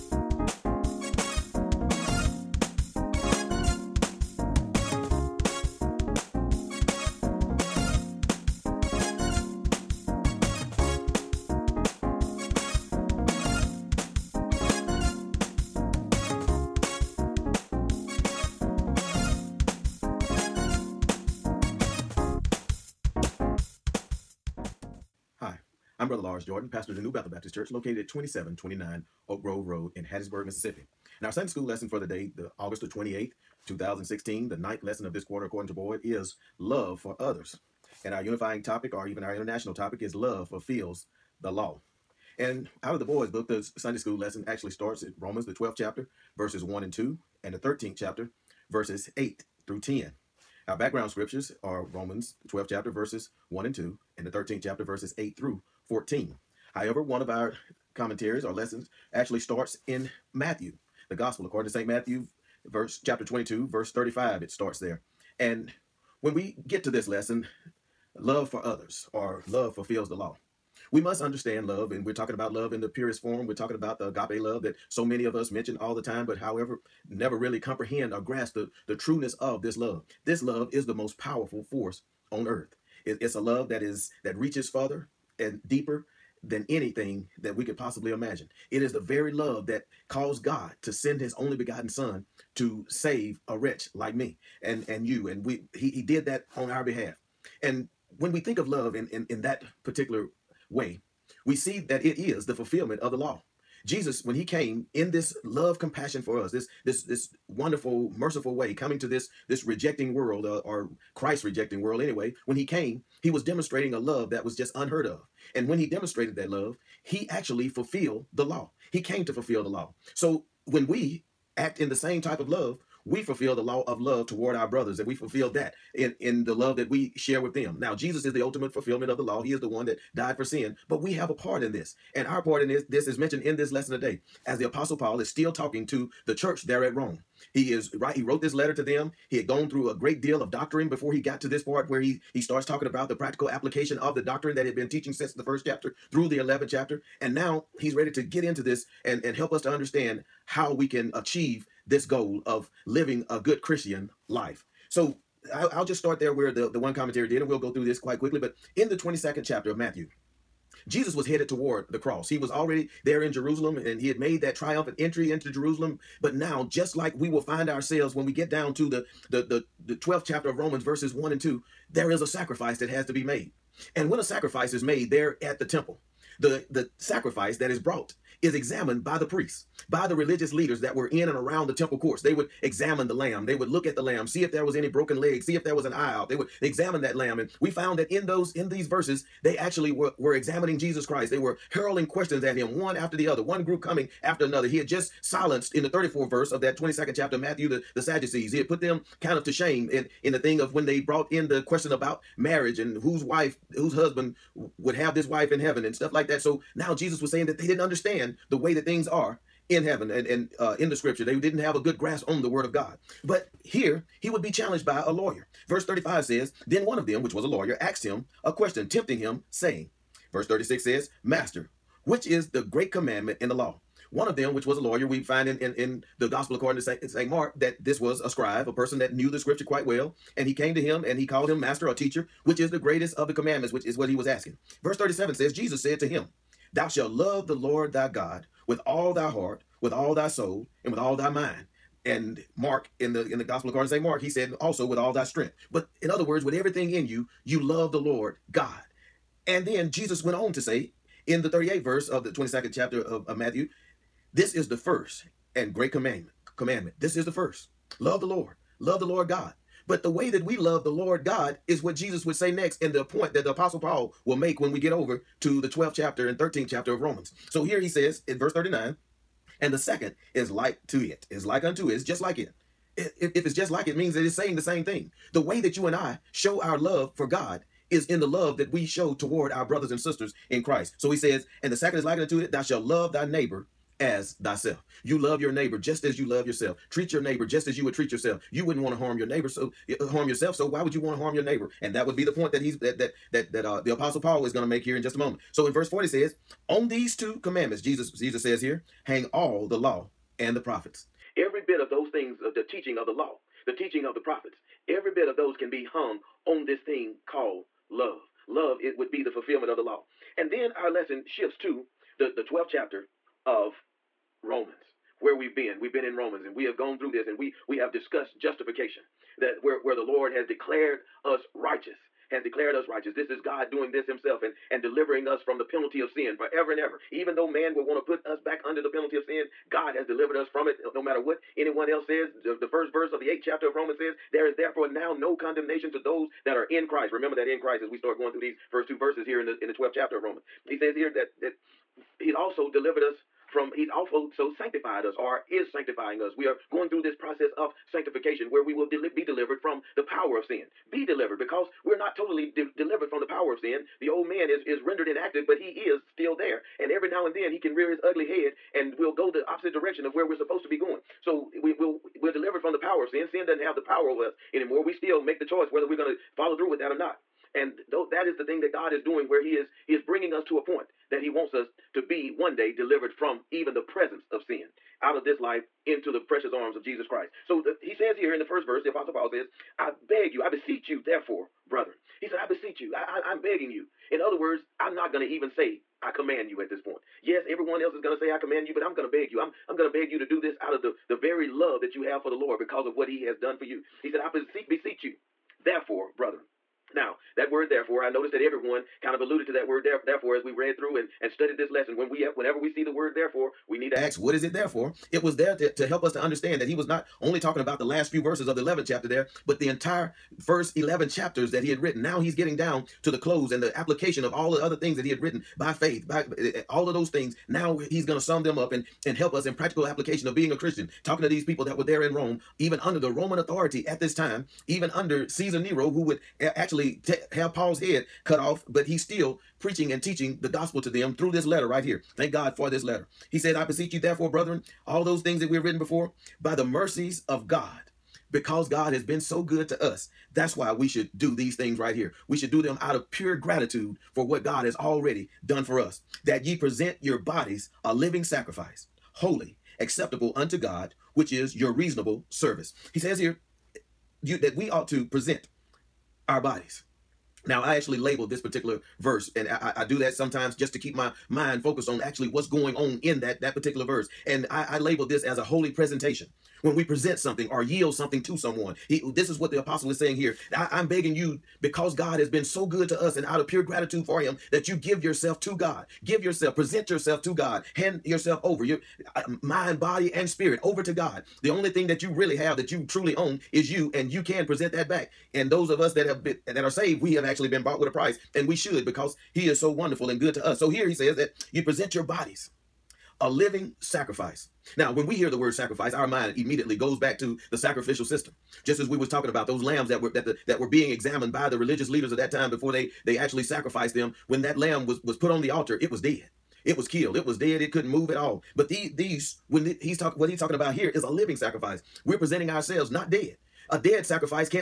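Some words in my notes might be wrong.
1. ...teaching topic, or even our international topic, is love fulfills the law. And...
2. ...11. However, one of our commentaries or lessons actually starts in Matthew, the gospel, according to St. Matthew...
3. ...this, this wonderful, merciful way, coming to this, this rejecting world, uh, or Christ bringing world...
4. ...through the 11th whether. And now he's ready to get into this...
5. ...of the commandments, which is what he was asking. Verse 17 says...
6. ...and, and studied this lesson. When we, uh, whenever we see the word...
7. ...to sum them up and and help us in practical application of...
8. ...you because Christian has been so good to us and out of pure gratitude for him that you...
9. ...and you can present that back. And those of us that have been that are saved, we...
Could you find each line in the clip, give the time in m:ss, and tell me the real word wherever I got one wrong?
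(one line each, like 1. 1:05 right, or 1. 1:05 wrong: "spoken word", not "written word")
1. 0:38 wrong: "unifying", not "teaching"
2. 0:55 wrong: "14", not "11"
3. 1:46 wrong: "rejecting", not "bringing"
4. 2:26 wrong: "chapter", not "whether"
5. 3:53 wrong: "37", not "17"
6. 6:40 right
7. 6:58 right
8. 7:51 wrong: "God", not "Christian"
9. 8:03 right.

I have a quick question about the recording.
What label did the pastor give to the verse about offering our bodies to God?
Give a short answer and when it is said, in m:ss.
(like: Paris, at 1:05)
A holy presentation, at 7:45.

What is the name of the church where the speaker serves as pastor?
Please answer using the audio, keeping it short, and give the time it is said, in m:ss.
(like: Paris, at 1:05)
New Bethel Baptist Church, at 0:27.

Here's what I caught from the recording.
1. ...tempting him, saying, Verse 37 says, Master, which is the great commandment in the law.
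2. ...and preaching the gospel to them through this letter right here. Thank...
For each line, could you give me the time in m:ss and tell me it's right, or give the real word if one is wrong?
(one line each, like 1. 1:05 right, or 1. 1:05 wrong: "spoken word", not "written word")
1. 3:38 wrong: "36", not "37"
2. 7:09 wrong: "teaching", not "preaching".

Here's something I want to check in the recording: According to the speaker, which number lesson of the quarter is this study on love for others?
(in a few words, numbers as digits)
9th.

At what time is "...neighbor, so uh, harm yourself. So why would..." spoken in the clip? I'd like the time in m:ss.
4:49.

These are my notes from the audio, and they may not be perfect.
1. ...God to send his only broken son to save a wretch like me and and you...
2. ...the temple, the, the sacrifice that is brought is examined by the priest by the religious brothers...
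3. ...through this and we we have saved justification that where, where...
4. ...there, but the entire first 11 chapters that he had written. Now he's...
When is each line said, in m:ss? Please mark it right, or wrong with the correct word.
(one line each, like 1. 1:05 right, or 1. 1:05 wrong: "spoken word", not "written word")
1. 1:30 wrong: "begotten", not "broken"
2. 2:55 wrong: "leaders", not "brothers"
3. 5:16 wrong: "discussed", not "saved"
4. 6:49 right.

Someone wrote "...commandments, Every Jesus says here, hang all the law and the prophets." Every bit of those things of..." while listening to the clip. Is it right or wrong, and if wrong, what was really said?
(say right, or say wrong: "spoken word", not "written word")
wrong: "Jesus", not "Every".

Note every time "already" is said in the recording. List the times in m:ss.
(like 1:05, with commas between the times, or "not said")
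2:42, 7:24.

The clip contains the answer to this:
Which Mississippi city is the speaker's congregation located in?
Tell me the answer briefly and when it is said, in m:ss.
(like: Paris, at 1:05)
Hattiesburg, at 0:30.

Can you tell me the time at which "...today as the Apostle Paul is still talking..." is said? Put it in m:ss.
2:13.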